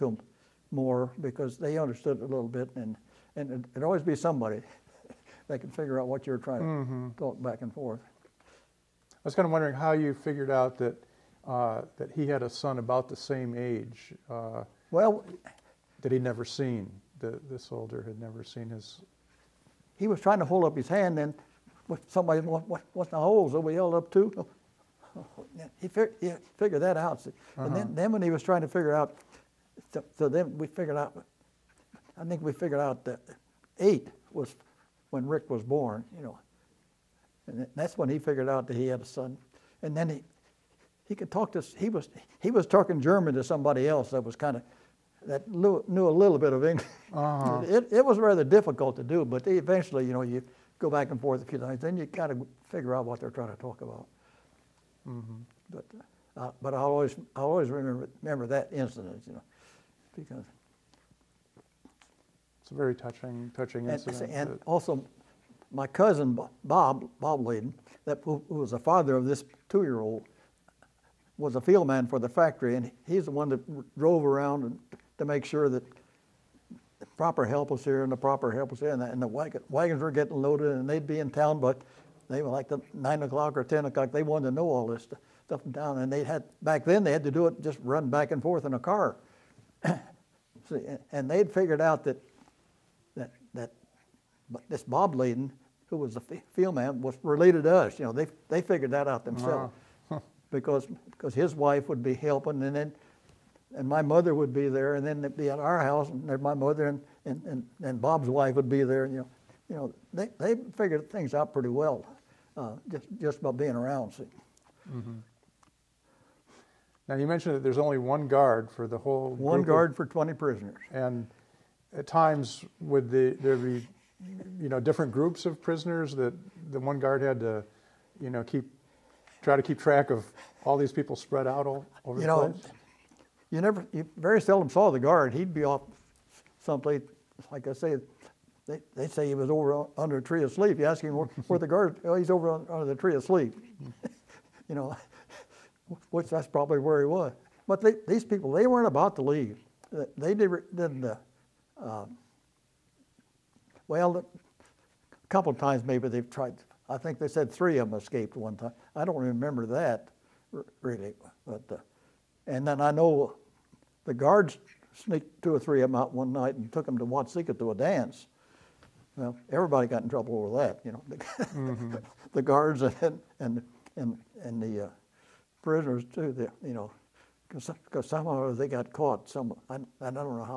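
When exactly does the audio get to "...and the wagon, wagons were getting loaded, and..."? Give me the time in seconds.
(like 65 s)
79 s.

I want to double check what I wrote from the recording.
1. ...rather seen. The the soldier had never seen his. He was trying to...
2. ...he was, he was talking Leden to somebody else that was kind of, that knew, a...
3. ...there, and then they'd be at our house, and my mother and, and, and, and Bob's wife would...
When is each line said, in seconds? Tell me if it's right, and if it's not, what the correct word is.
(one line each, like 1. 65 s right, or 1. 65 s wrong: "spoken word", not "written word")
1. 16 s wrong: "never", not "rather"
2. 41 s wrong: "German", not "Leden"
3. 104 s right.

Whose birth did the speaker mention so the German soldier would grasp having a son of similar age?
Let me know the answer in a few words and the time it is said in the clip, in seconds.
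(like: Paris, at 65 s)
Rick, at 35 s.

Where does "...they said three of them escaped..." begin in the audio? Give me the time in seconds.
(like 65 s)
157 s.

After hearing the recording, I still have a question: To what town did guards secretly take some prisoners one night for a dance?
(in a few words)
Watseka.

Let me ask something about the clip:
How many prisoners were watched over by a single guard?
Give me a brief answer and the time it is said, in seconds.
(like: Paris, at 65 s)
20, at 120 s.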